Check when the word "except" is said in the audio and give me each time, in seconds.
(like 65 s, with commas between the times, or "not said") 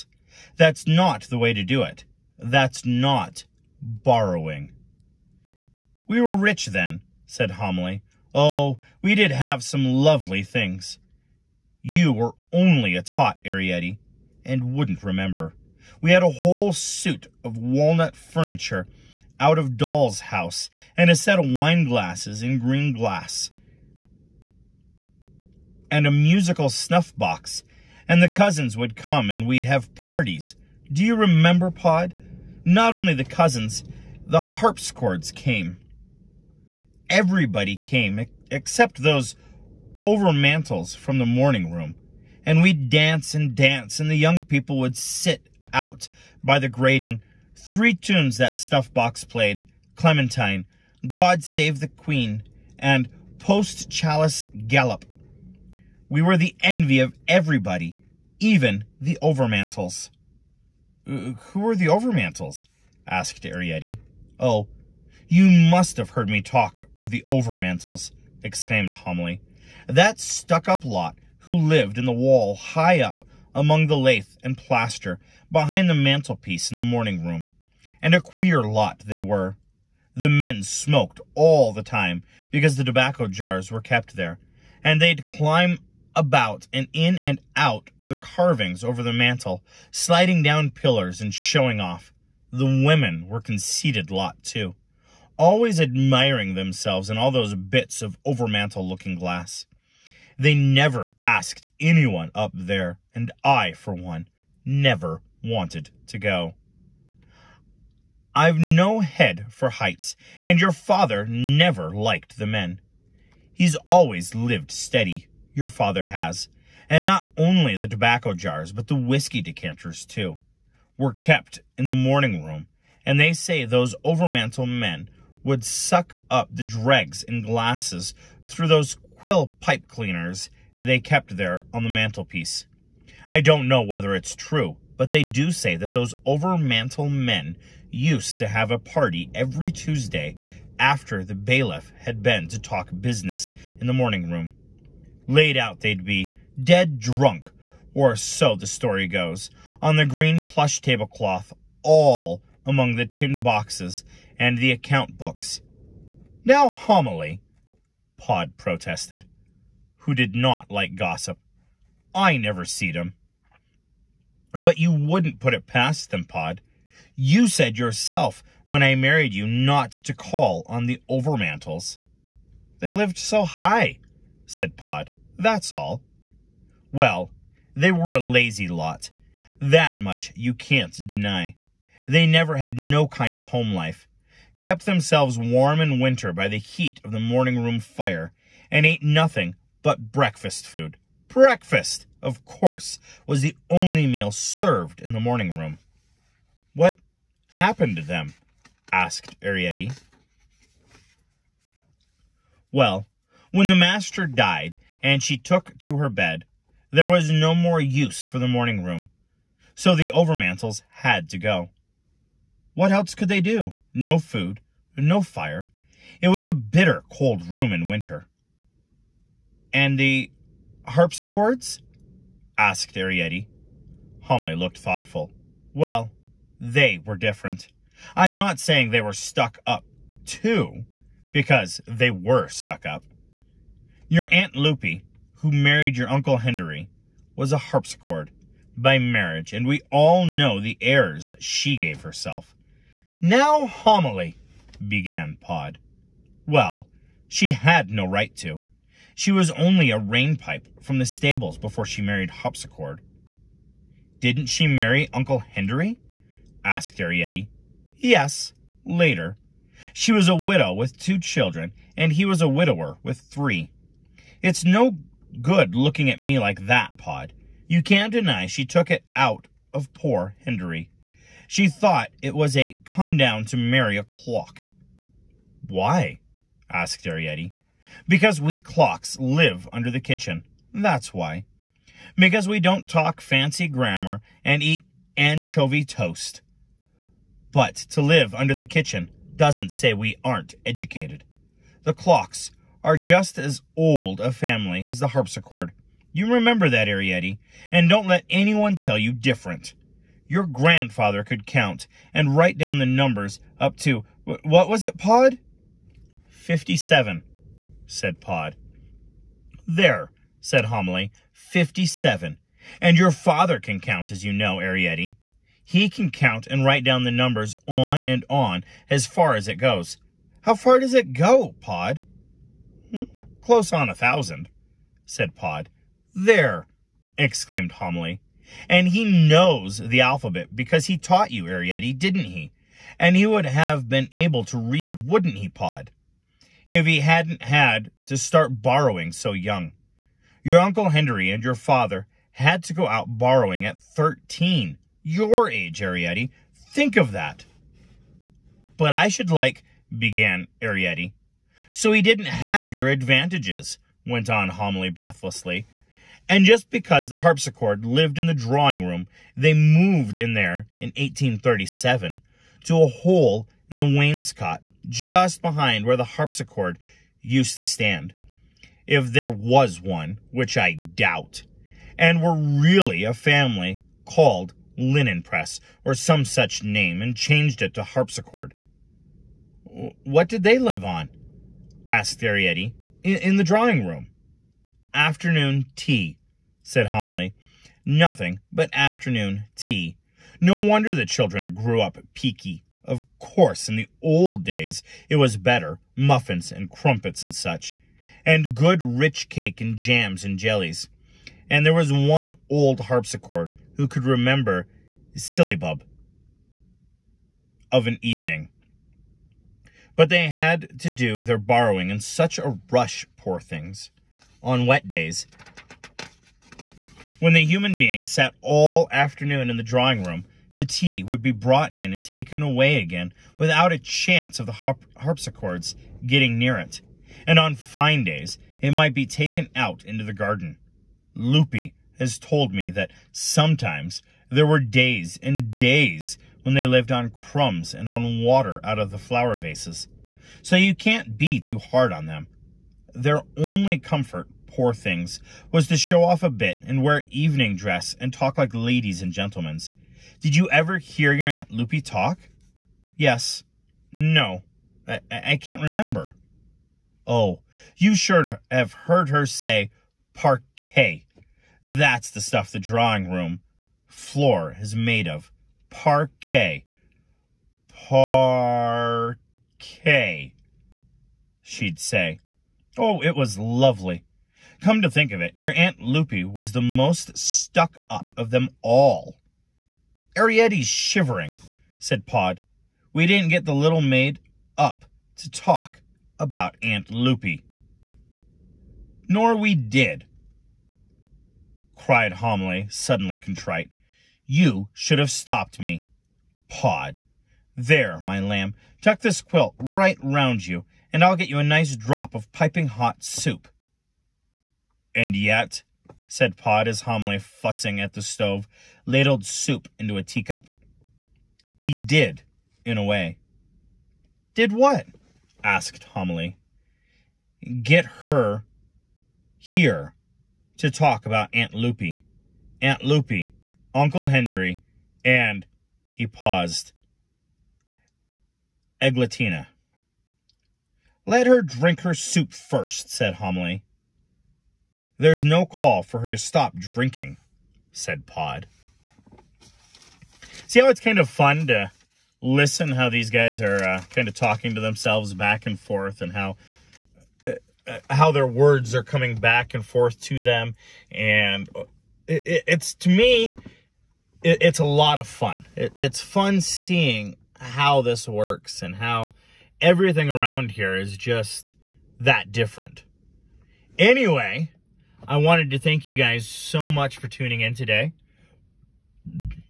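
38 s.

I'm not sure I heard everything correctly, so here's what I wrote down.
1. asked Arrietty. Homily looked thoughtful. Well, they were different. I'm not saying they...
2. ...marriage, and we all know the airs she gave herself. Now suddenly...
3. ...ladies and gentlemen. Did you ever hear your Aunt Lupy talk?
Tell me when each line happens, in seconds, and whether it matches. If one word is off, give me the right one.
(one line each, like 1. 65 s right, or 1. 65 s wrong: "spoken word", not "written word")
1. 222 s right
2. 238 s wrong: "homily", not "suddenly"
3. 448 s right.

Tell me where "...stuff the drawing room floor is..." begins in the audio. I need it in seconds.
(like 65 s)
462 s.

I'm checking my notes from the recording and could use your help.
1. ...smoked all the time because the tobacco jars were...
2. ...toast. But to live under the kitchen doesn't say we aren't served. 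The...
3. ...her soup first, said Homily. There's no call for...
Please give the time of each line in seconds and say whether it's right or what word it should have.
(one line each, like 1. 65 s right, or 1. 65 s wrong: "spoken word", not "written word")
1. 80 s right
2. 285 s wrong: "educated", not "served"
3. 531 s right.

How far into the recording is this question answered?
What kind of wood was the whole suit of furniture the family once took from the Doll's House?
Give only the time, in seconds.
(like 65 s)
17 s.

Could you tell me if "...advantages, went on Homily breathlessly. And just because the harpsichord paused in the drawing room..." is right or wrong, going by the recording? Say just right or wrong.
wrong.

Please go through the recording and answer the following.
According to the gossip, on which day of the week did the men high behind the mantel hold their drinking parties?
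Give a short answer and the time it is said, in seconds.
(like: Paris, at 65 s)
Tuesday, at 139 s.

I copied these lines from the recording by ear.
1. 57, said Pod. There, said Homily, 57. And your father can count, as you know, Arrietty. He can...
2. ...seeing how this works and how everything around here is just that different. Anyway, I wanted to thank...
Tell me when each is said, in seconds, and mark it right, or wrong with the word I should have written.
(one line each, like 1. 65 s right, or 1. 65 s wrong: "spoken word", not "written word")
1. 306 s right
2. 556 s right.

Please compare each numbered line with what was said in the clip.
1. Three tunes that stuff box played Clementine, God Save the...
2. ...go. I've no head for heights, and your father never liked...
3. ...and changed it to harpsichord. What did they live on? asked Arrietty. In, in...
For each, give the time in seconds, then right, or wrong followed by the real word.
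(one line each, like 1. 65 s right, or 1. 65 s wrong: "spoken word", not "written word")
1. 47 s right
2. 106 s right
3. 377 s right.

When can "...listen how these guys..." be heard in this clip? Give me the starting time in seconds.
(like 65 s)
542 s.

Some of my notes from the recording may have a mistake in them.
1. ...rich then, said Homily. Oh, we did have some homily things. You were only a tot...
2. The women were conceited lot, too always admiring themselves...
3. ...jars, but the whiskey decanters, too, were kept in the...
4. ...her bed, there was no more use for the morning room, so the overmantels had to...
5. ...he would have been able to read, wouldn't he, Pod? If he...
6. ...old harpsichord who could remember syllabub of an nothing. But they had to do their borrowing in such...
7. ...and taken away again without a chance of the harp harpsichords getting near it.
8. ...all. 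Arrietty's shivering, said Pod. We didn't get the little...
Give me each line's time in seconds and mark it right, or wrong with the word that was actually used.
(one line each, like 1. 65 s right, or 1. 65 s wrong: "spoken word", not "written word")
1. 6 s wrong: "lovely", not "homily"
2. 92 s right
3. 118 s right
4. 205 s right
5. 333 s right
6. 402 s wrong: "evening", not "nothing"
7. 421 s right
8. 478 s right.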